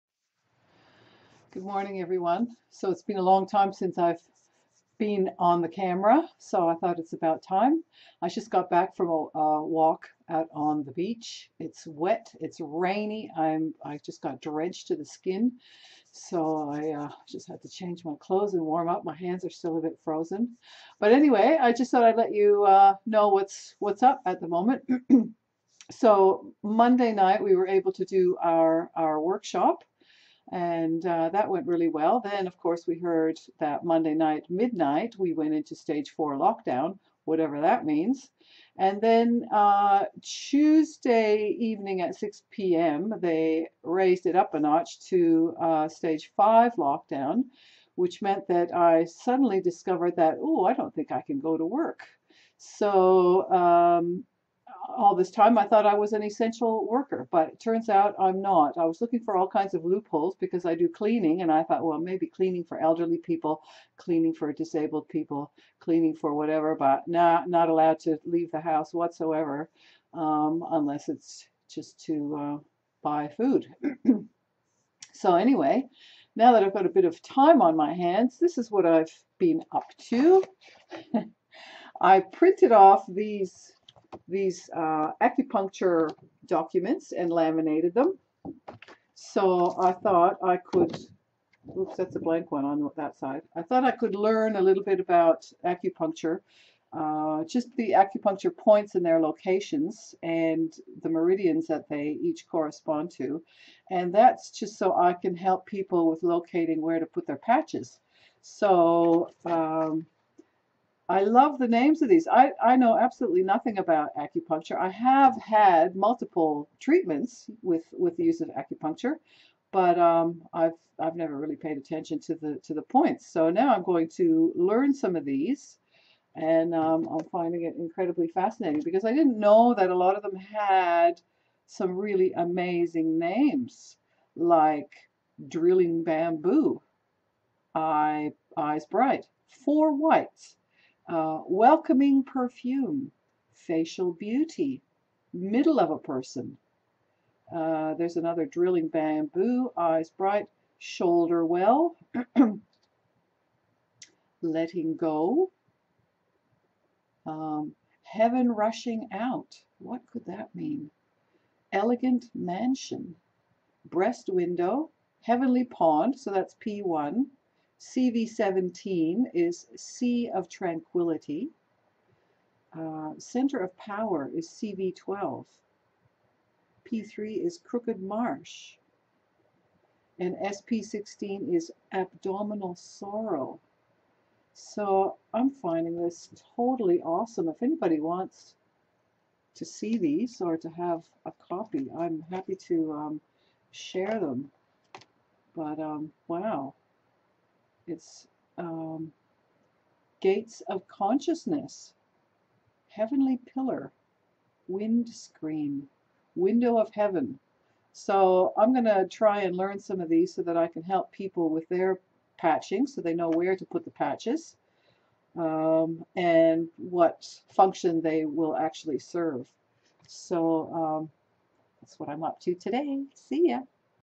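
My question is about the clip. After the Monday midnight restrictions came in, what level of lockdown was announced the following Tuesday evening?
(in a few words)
Stage 5.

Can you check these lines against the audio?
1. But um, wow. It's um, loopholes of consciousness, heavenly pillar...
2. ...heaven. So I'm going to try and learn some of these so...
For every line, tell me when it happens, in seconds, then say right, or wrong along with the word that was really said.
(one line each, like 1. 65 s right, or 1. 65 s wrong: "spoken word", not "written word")
1. 195 s wrong: "gates", not "loopholes"
2. 206 s right.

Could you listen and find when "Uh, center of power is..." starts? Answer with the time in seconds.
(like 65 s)
172 s.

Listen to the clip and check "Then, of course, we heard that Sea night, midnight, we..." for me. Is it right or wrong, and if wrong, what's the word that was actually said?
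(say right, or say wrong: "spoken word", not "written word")
wrong: "Monday", not "Sea".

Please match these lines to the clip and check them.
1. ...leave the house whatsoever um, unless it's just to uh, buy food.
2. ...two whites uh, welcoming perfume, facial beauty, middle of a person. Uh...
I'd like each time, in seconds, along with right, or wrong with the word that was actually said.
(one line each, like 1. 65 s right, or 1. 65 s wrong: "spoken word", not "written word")
1. 68 s right
2. 139 s wrong: "four", not "two".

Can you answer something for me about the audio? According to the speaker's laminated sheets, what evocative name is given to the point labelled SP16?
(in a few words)
Abdominal sorrow.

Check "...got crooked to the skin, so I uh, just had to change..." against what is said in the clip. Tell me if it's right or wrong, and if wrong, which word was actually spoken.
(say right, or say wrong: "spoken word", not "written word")
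wrong: "drenched", not "crooked".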